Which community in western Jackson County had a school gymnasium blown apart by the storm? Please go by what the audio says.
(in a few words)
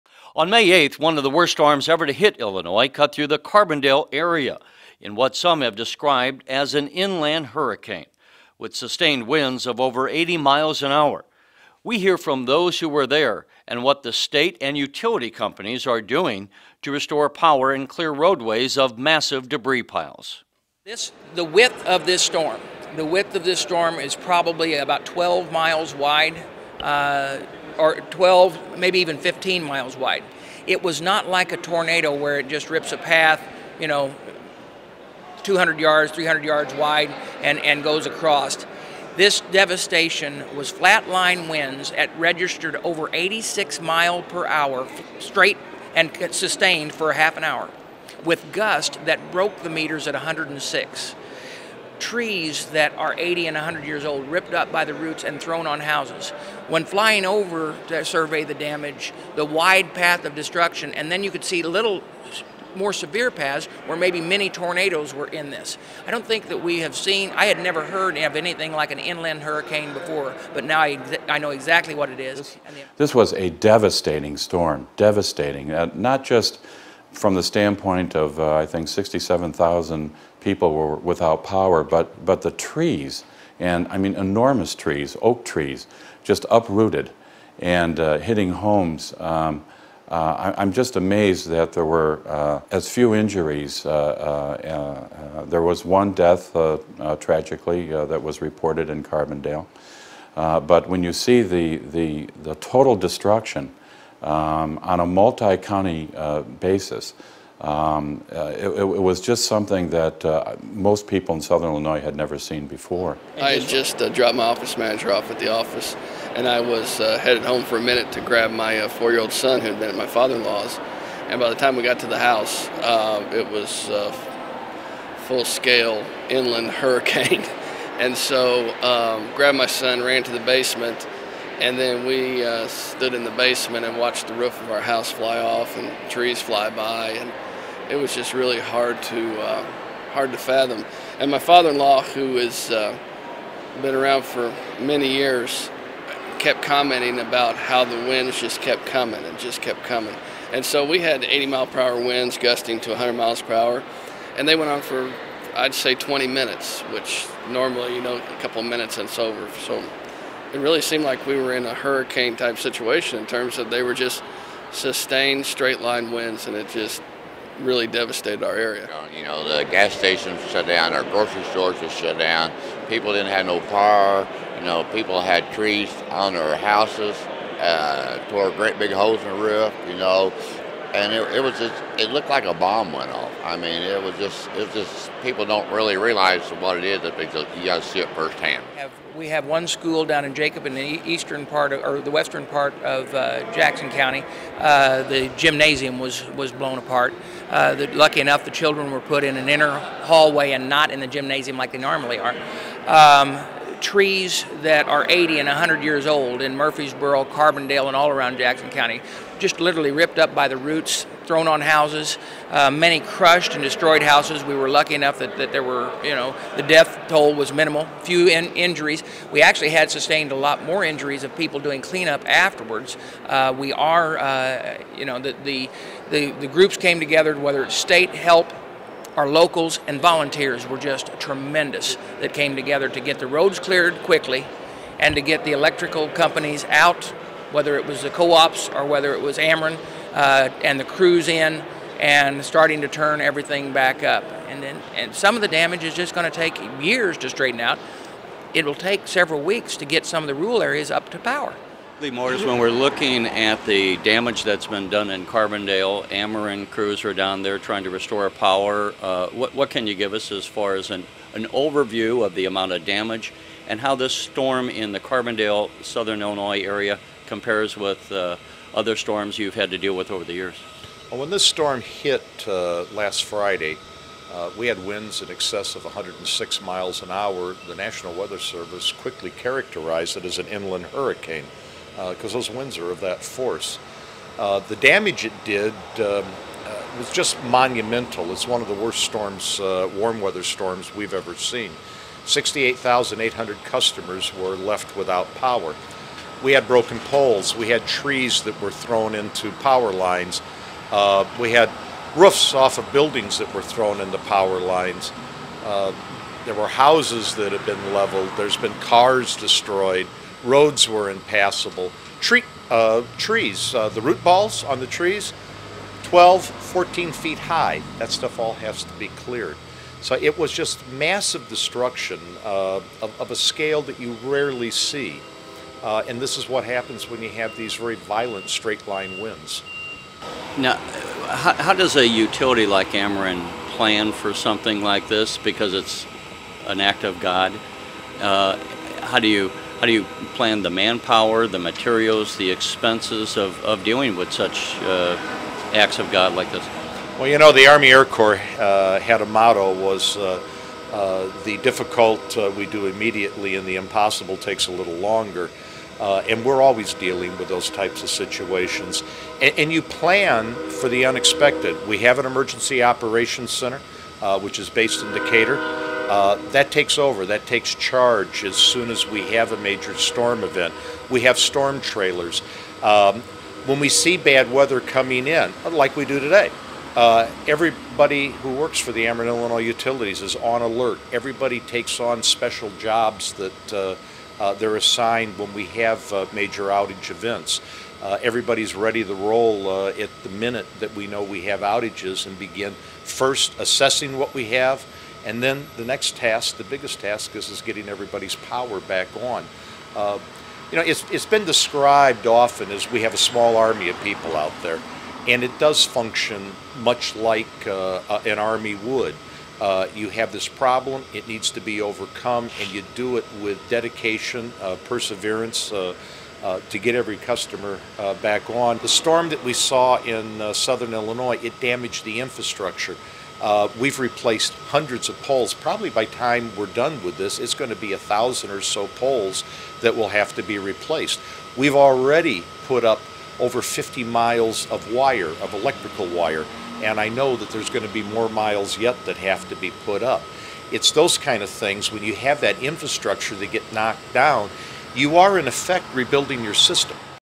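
Jacob.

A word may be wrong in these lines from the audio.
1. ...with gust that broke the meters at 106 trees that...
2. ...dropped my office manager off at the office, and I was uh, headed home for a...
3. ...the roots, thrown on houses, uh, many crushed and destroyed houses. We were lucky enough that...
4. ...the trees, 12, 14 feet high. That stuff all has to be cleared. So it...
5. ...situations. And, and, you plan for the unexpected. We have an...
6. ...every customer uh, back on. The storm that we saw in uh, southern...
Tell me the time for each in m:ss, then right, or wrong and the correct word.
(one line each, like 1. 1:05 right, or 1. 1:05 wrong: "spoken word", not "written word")
1. 0:48 right
2. 1:54 right
3. 3:30 right
4. 5:14 right
5. 5:58 right
6. 6:56 right.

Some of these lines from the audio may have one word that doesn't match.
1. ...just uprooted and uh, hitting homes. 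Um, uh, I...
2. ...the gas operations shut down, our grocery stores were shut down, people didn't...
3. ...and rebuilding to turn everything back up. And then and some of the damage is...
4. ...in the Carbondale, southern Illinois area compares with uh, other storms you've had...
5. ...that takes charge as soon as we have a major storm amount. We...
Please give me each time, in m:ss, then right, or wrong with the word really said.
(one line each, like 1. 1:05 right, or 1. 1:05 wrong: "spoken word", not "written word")
1. 1:26 right
2. 2:49 wrong: "stations", not "operations"
3. 4:01 wrong: "starting", not "rebuilding"
4. 4:24 right
5. 6:07 wrong: "event", not "amount".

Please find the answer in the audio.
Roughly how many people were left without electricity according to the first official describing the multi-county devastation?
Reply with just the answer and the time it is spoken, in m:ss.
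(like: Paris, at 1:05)
67,000, at 1:18.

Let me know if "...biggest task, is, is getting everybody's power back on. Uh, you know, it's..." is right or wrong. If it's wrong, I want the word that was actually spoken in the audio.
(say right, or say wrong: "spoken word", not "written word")
right.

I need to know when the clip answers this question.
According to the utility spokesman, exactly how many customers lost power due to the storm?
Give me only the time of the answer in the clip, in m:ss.
4:52.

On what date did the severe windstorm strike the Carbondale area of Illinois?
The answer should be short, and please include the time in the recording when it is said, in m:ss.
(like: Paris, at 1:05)
May 8th, at 0:00.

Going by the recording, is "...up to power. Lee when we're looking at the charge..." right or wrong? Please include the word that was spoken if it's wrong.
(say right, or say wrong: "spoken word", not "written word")
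wrong: "damage", not "charge".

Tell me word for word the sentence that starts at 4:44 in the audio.
Uh, the damage it did um, uh, was just monumental.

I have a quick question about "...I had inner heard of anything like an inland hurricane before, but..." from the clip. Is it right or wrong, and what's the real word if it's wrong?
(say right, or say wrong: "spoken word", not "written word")
wrong: "never", not "inner".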